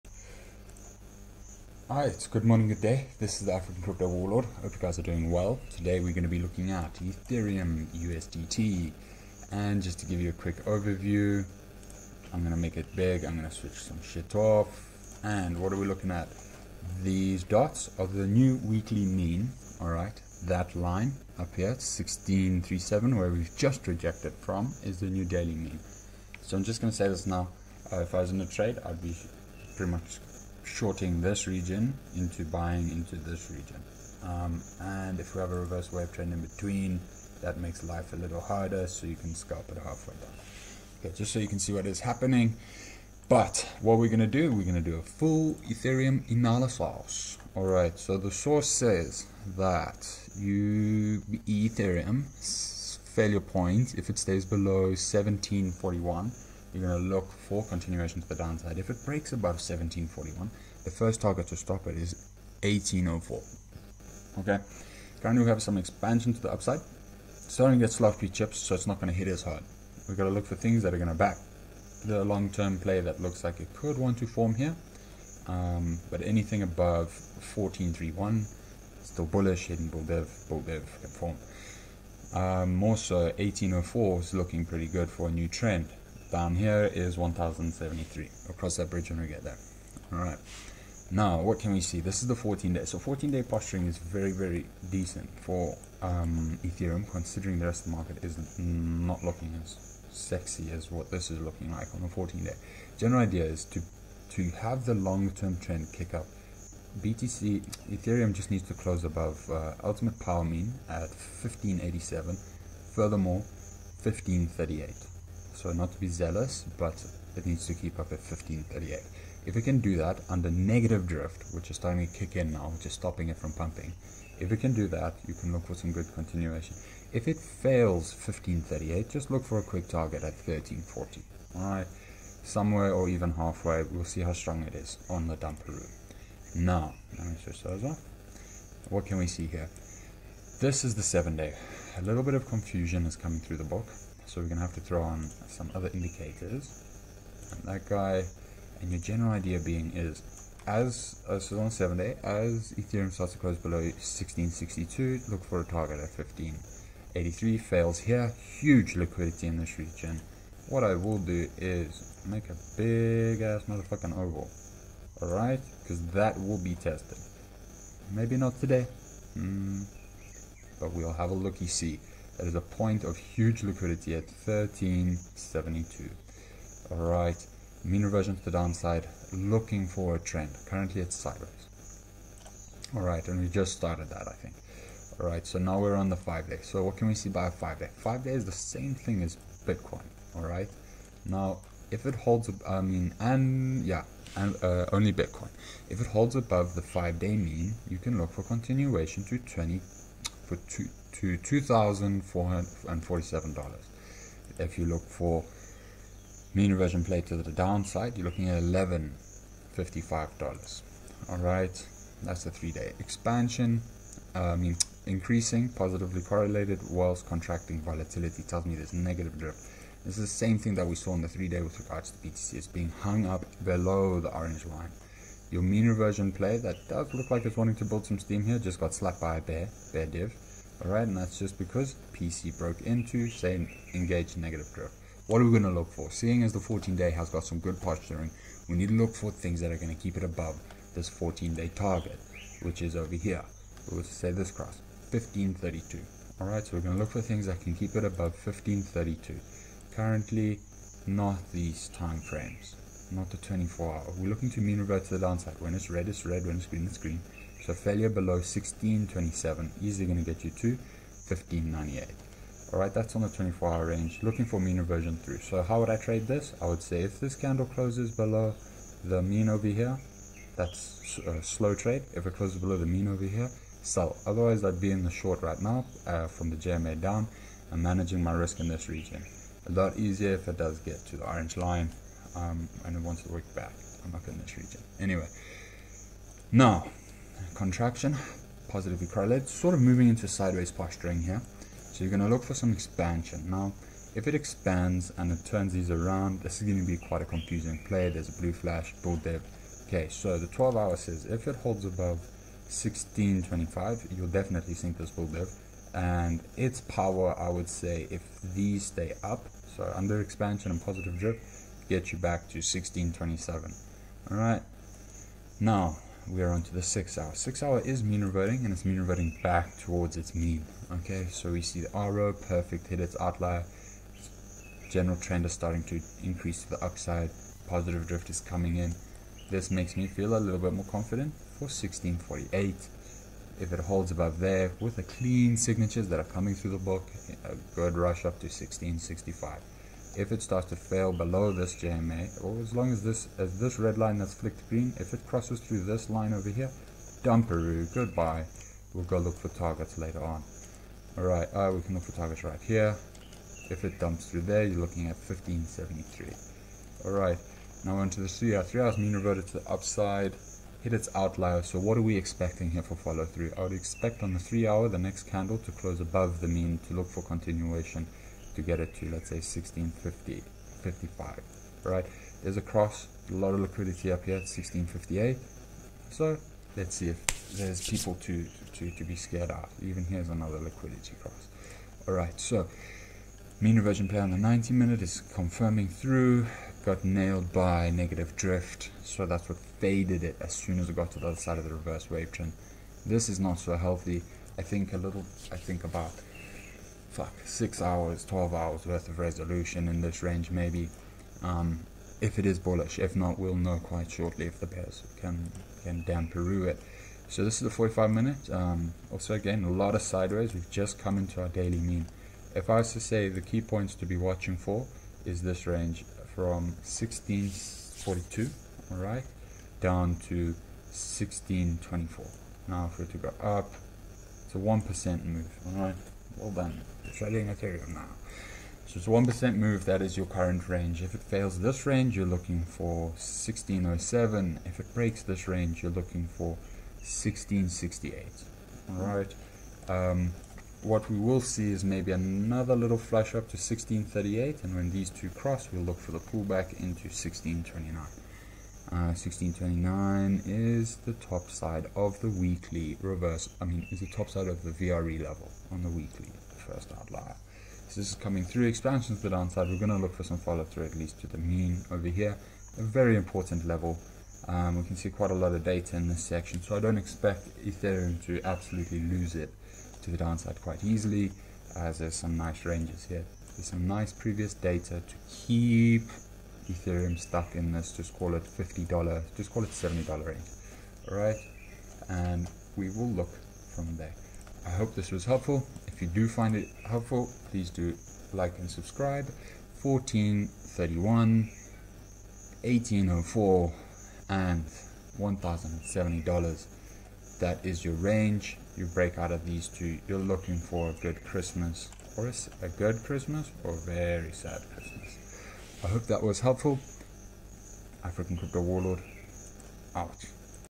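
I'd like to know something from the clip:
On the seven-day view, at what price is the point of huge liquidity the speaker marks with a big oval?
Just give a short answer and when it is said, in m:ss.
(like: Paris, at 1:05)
1372, at 2:54.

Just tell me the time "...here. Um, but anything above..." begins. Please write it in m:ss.
1:14.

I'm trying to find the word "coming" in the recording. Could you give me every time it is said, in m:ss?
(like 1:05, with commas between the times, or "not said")
2:23, 5:28, 5:36, 7:38.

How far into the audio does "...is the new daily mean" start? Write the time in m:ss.
0:24.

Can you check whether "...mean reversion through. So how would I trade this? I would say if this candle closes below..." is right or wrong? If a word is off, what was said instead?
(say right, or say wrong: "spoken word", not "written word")
right.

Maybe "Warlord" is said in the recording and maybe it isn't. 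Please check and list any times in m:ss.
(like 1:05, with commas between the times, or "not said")
0:04, 8:28.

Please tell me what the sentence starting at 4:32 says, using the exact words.
If it closes below the mean over here, sell.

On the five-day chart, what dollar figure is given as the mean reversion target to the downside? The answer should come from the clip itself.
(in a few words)
$1,155.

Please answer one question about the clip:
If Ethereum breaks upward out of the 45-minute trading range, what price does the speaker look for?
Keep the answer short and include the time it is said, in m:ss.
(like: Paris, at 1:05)
1668, at 7:16.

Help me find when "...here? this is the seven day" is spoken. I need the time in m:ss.
2:19.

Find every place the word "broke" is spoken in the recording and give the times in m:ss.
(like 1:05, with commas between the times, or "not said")
3:52.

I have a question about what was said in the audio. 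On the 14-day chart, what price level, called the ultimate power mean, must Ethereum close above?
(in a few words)
1587.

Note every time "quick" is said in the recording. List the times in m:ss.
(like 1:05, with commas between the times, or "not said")
0:10, 2:09.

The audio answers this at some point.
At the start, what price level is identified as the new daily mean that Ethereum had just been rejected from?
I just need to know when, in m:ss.
0:21.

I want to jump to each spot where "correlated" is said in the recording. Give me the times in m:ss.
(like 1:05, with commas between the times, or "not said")
3:36, 4:49.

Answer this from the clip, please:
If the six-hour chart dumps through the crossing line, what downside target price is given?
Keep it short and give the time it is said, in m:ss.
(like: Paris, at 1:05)
1573, at 5:55.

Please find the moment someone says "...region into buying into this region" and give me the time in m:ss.
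0:31.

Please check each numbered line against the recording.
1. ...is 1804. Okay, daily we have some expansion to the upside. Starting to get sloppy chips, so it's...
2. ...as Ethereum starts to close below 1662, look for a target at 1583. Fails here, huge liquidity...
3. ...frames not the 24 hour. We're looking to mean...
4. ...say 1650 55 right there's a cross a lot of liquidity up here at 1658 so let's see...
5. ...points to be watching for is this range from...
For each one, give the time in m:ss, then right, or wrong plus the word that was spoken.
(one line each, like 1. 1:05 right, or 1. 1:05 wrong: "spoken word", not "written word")
1. 1:01 wrong: "currently", not "daily"
2. 2:32 right
3. 4:12 right
4. 6:09 right
5. 6:53 right.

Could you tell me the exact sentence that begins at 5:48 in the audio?
We'll go look for targets later on.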